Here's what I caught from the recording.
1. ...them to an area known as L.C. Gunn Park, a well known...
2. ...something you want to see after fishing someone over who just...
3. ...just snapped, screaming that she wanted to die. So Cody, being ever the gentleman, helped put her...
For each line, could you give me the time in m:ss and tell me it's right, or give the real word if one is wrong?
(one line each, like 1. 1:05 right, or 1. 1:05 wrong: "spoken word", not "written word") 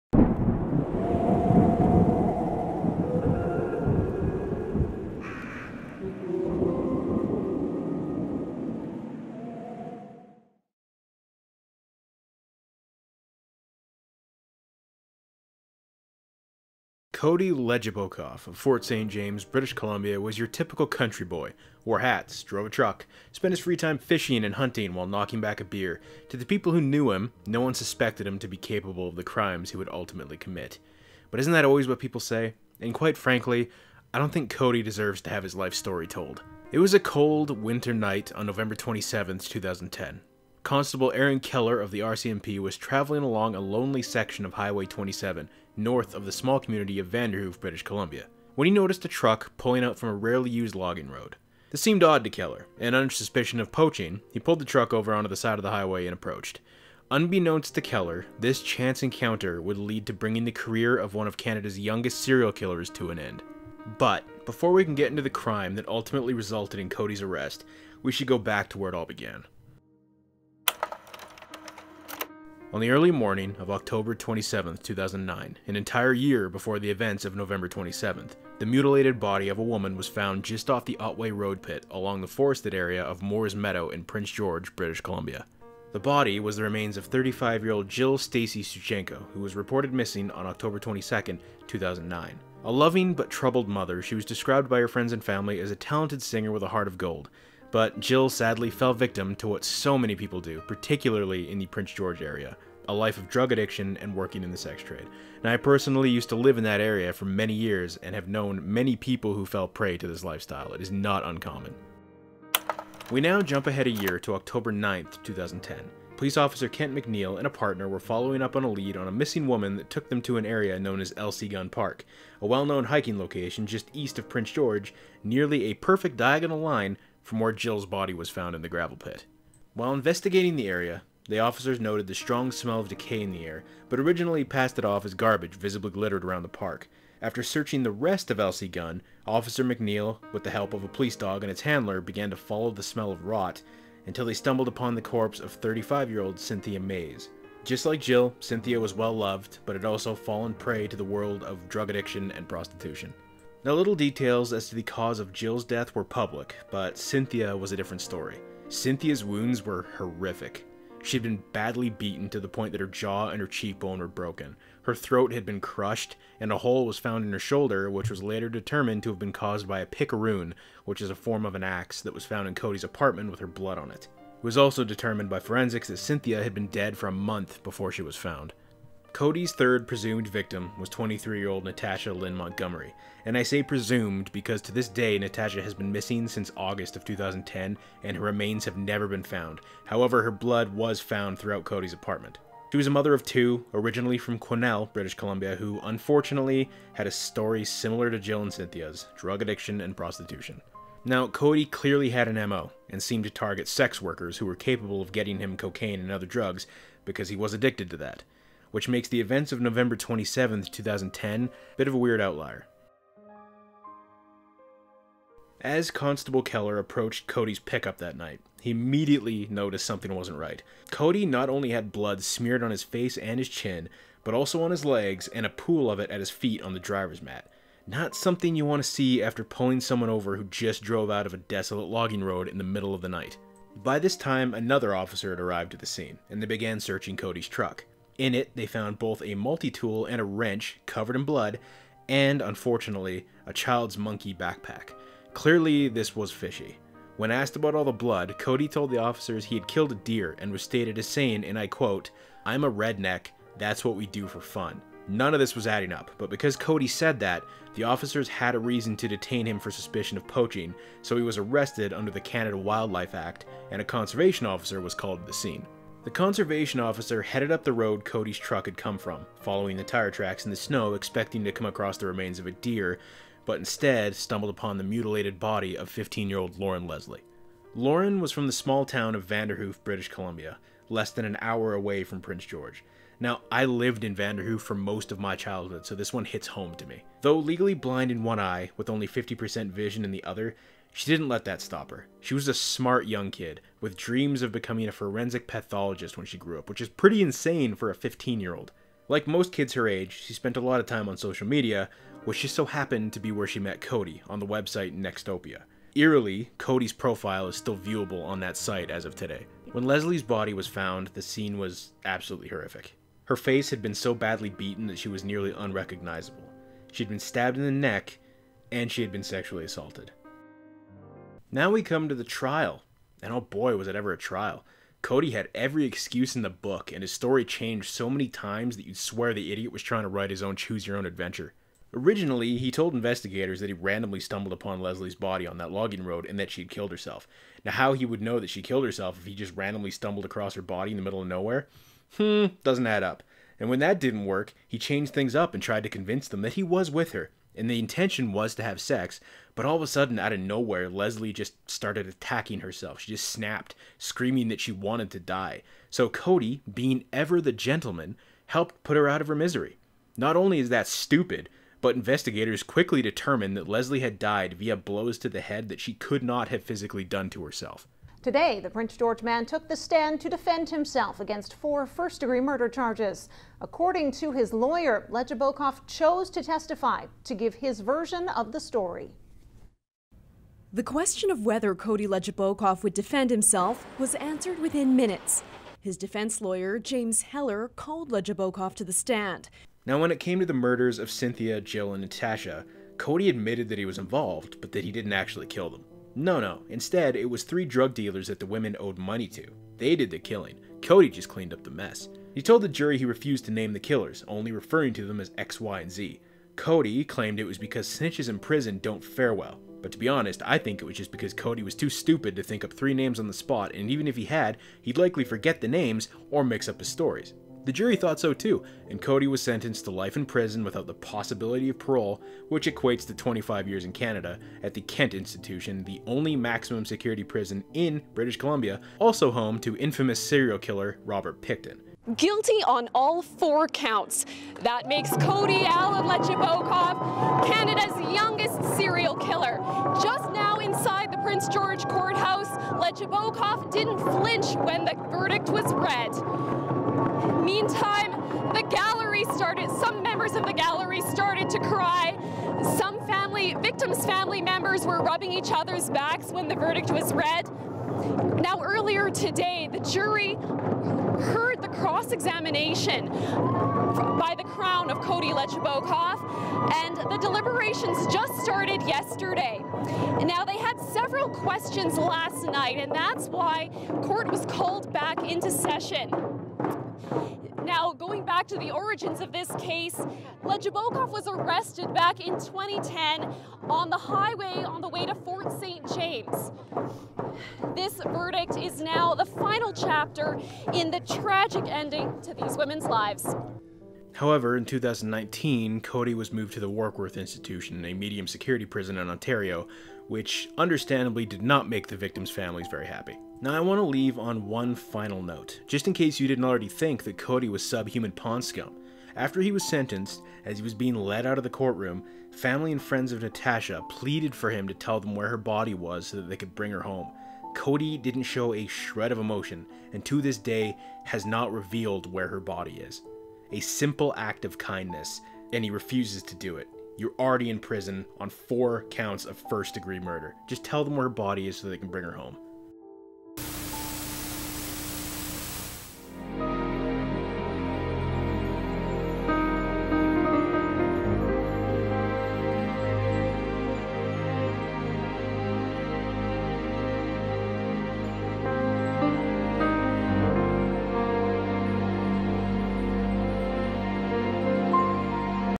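1. 2:00 right
2. 3:48 wrong: "pulling", not "fishing"
3. 5:53 right.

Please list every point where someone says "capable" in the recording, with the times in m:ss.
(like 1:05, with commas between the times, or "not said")
0:28, 3:24.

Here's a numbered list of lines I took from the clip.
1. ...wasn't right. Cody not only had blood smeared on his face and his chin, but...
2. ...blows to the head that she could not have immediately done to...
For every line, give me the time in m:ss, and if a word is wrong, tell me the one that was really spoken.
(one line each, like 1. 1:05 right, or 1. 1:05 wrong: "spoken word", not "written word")
1. 3:40 right
2. 6:04 wrong: "physically", not "immediately".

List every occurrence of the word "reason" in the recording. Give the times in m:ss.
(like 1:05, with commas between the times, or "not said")
4:18.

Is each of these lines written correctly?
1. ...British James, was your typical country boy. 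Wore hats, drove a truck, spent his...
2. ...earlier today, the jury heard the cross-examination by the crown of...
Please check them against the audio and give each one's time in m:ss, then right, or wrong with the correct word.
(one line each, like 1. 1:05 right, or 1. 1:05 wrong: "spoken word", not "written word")
1. 0:19 wrong: "Columbia", not "James"
2. 7:38 right.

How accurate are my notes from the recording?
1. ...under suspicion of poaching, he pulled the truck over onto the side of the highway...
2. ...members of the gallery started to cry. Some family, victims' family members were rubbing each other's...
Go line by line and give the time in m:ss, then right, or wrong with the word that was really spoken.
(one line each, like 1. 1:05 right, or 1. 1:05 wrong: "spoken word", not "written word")
1. 0:52 right
2. 7:30 right.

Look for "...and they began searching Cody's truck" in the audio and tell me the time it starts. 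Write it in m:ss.
3:56.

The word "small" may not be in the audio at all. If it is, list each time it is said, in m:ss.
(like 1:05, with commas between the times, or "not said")
0:46, 4:38.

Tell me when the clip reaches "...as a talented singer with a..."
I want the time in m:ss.
1:35.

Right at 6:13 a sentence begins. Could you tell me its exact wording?
According to his lawyer, Legebokoff chose to testify to give his version of the story.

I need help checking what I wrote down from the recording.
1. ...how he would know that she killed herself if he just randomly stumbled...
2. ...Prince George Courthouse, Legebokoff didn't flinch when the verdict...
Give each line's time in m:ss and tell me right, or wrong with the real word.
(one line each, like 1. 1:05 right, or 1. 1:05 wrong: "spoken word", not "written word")
1. 5:37 right
2. 7:21 right.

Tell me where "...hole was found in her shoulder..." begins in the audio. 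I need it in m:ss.
2:46.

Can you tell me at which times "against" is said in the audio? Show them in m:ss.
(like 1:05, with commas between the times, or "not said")
6:11.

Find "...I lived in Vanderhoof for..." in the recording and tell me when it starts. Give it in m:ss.
4:43.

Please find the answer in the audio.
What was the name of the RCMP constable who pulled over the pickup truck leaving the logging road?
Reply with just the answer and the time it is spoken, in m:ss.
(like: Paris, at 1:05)
Aaron Keller, at 0:41.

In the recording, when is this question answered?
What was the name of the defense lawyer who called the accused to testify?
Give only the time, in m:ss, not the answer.
6:26.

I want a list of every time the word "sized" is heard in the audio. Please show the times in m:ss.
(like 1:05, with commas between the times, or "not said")
not said.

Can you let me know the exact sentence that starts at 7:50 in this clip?
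Now, they had several questions last night, and that's why court was called back into session.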